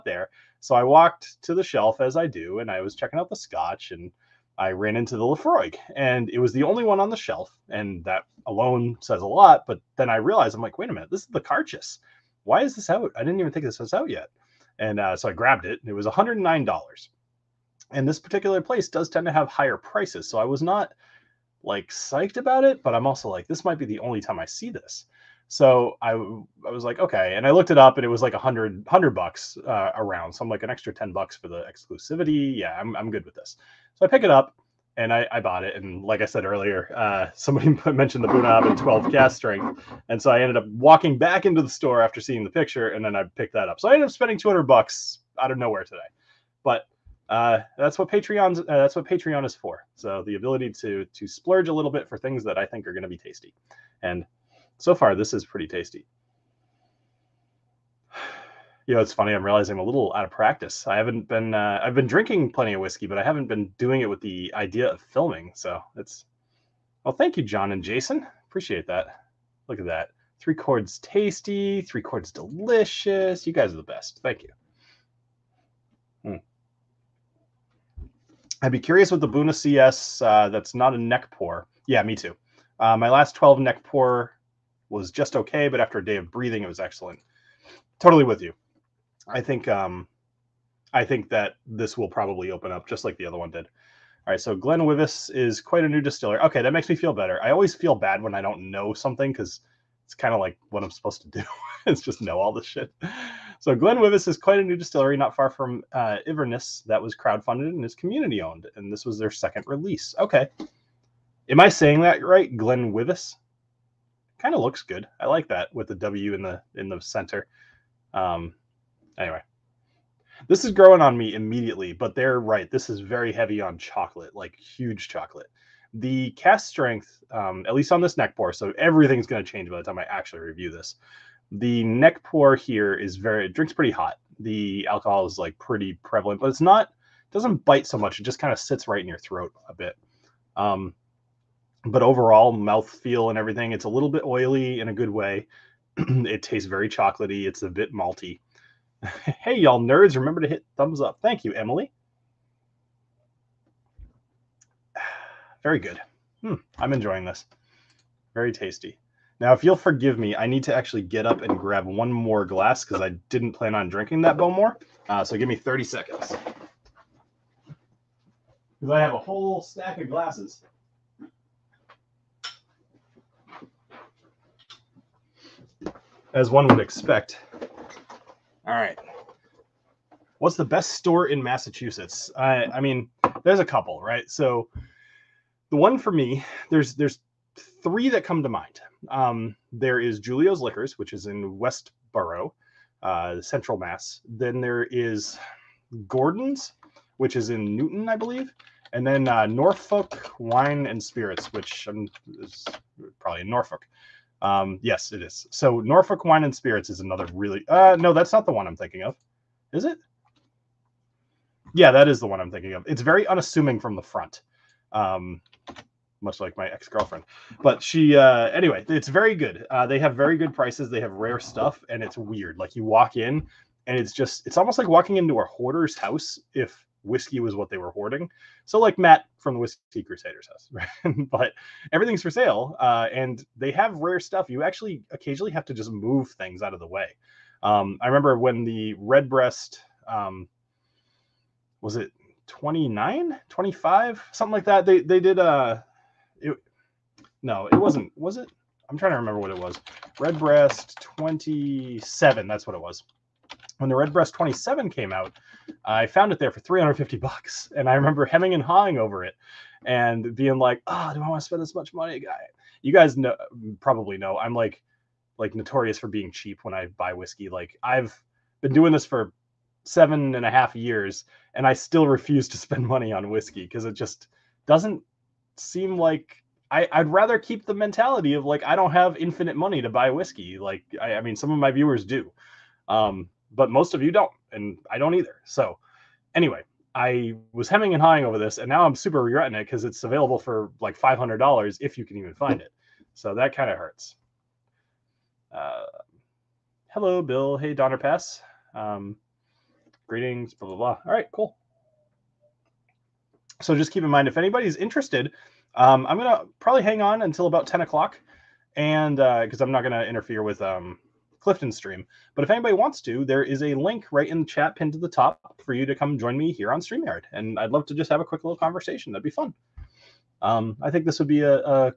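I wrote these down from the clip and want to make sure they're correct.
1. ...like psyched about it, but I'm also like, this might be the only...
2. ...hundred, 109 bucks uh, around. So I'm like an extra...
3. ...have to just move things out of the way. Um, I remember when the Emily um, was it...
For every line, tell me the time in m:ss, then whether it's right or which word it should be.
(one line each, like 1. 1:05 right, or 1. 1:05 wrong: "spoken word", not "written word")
1. 0:21 right
2. 0:28 wrong: "100", not "109"
3. 3:55 wrong: "Redbreast", not "Emily".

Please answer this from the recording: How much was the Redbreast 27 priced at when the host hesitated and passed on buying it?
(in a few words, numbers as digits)
$350.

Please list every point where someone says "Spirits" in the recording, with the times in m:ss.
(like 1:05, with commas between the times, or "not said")
3:21, 3:26.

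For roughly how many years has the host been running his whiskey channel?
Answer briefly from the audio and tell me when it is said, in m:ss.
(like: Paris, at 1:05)
7.5, at 4:29.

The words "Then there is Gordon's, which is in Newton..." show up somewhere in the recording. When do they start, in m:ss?
3:14.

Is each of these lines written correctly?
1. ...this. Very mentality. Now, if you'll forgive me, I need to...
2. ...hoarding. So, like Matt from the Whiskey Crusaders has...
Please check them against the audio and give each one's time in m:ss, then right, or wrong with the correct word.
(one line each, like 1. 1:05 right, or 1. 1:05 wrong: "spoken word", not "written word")
1. 2:37 wrong: "tasty", not "mentality"
2. 3:47 right.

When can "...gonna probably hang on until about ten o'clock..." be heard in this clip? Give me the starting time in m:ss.
5:06.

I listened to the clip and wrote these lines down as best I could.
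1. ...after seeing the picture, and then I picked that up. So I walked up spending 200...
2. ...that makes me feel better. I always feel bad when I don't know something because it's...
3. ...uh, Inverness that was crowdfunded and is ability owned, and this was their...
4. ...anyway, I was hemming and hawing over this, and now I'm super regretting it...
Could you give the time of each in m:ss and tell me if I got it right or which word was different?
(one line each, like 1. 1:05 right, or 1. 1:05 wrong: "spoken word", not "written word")
1. 0:42 wrong: "ended", not "walked"
2. 1:36 right
3. 1:45 wrong: "community", not "ability"
4. 4:46 right.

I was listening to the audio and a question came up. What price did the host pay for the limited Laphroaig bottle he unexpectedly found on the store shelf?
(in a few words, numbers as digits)
$109.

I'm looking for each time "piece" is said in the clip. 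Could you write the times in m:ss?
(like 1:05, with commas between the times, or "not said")
not said.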